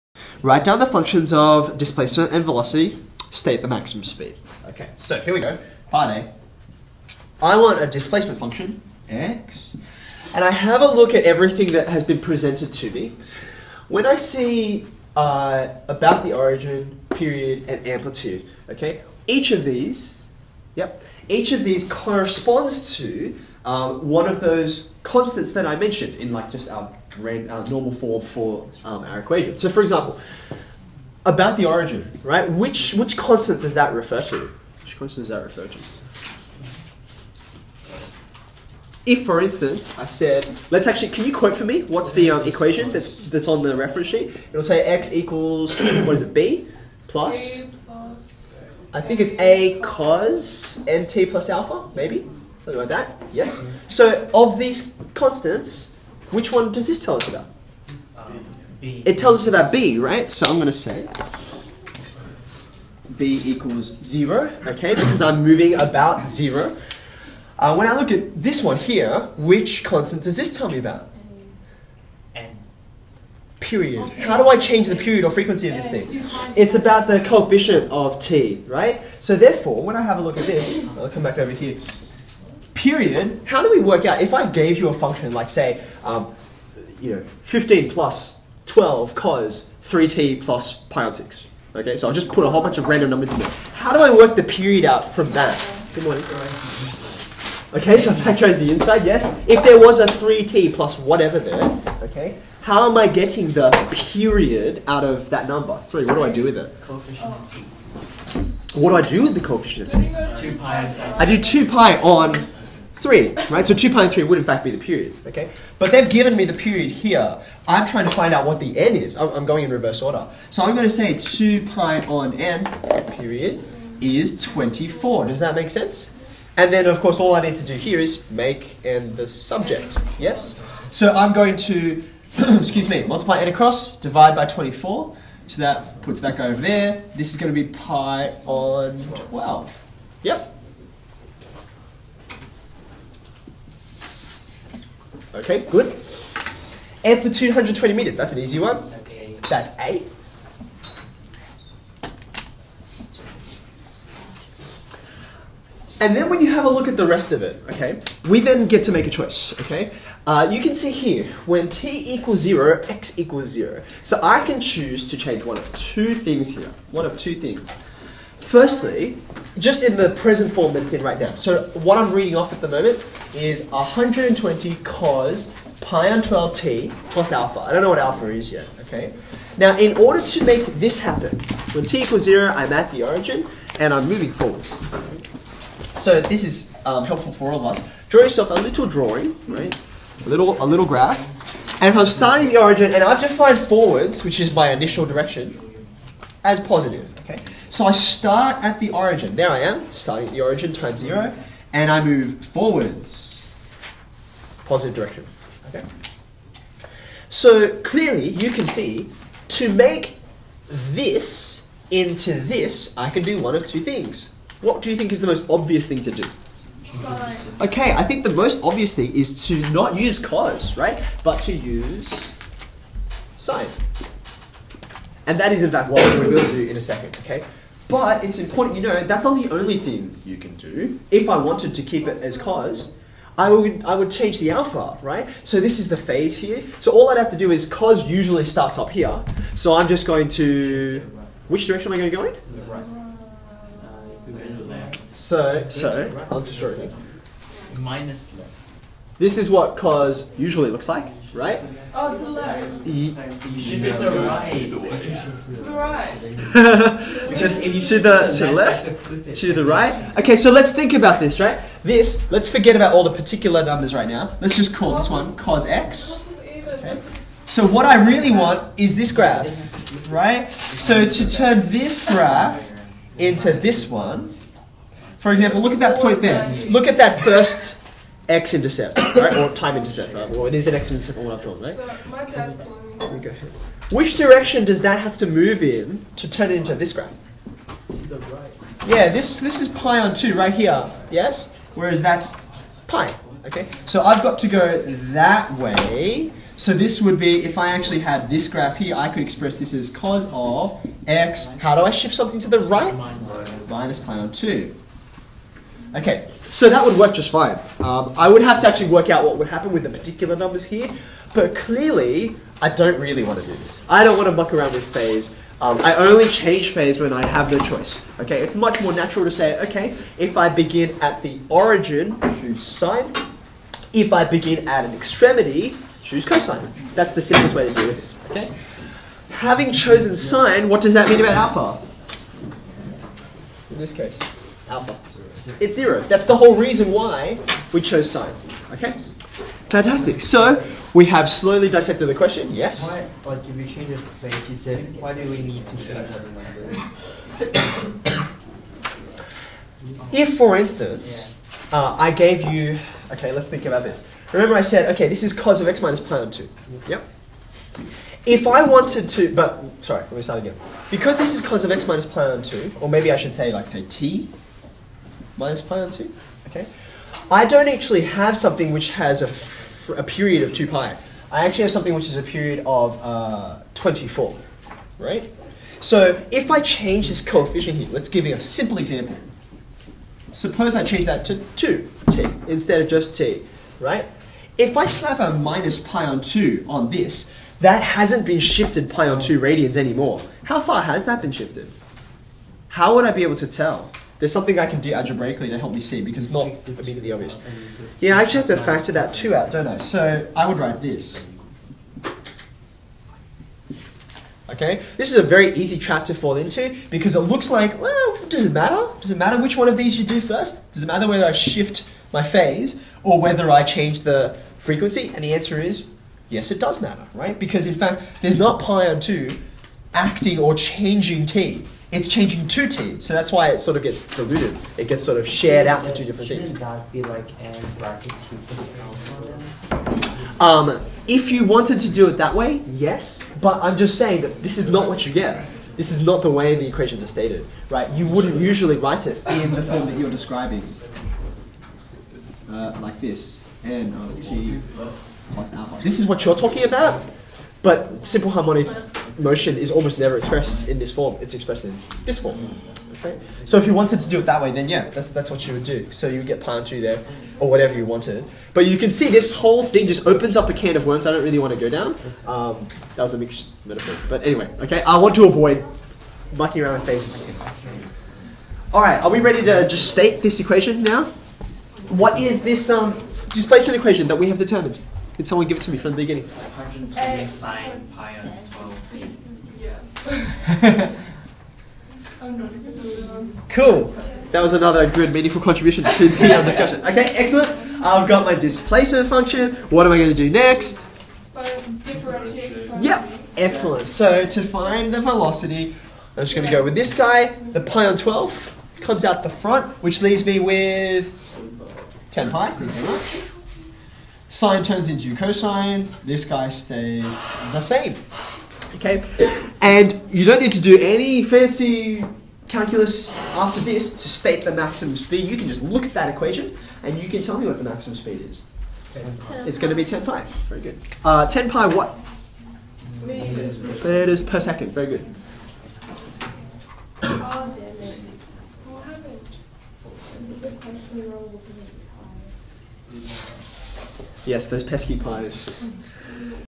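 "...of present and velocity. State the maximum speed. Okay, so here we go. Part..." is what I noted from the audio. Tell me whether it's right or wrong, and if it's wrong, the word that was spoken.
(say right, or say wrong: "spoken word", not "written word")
wrong: "displacement", not "present".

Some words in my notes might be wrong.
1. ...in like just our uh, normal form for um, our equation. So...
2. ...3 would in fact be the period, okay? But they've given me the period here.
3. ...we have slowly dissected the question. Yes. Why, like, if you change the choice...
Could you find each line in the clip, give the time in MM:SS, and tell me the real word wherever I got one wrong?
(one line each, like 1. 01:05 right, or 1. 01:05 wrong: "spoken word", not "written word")
1. 00:26 right
2. 01:54 right
3. 05:40 wrong: "space", not "choice".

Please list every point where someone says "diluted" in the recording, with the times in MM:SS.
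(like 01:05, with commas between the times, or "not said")
07:04.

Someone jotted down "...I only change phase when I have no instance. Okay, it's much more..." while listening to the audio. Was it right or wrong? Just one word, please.
wrong.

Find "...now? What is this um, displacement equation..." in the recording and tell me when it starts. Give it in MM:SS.
07:50.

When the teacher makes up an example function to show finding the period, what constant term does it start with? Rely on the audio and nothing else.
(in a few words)
15.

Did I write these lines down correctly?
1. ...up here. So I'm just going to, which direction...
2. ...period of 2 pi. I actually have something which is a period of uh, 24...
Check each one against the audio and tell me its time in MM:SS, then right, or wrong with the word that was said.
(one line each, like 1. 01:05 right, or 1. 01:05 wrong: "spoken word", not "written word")
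1. 03:58 right
2. 06:10 right.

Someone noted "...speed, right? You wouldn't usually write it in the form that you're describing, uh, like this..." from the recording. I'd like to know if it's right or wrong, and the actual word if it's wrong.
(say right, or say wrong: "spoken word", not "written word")
wrong: "stated", not "speed".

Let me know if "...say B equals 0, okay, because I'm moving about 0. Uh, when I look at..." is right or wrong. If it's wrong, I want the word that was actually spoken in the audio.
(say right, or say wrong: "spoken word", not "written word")
right.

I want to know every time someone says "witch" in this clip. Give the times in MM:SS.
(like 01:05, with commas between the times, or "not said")
not said.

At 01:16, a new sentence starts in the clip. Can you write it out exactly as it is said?
It's about the coefficient of t, right?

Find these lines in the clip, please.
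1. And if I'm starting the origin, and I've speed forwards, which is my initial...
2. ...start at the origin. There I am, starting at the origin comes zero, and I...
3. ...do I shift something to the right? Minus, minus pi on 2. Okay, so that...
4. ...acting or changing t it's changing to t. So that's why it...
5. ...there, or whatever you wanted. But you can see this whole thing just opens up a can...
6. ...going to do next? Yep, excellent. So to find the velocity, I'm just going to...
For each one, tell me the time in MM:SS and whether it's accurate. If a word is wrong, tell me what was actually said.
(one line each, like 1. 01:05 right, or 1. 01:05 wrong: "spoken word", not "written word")
1. 03:11 wrong: "defined", not "speed"
2. 03:17 wrong: "times", not "comes"
3. 05:01 right
4. 06:59 right
5. 07:36 right
6. 08:09 right.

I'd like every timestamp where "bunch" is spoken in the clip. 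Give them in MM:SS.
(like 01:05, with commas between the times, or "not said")
01:32.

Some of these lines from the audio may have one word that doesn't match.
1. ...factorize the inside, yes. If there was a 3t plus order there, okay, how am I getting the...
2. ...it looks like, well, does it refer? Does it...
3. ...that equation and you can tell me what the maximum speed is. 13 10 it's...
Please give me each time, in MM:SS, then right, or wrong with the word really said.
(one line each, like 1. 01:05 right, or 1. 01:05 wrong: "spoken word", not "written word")
1. 01:38 wrong: "whatever", not "order"
2. 06:47 wrong: "matter", not "refer"
3. 08:35 wrong: "10", not "13".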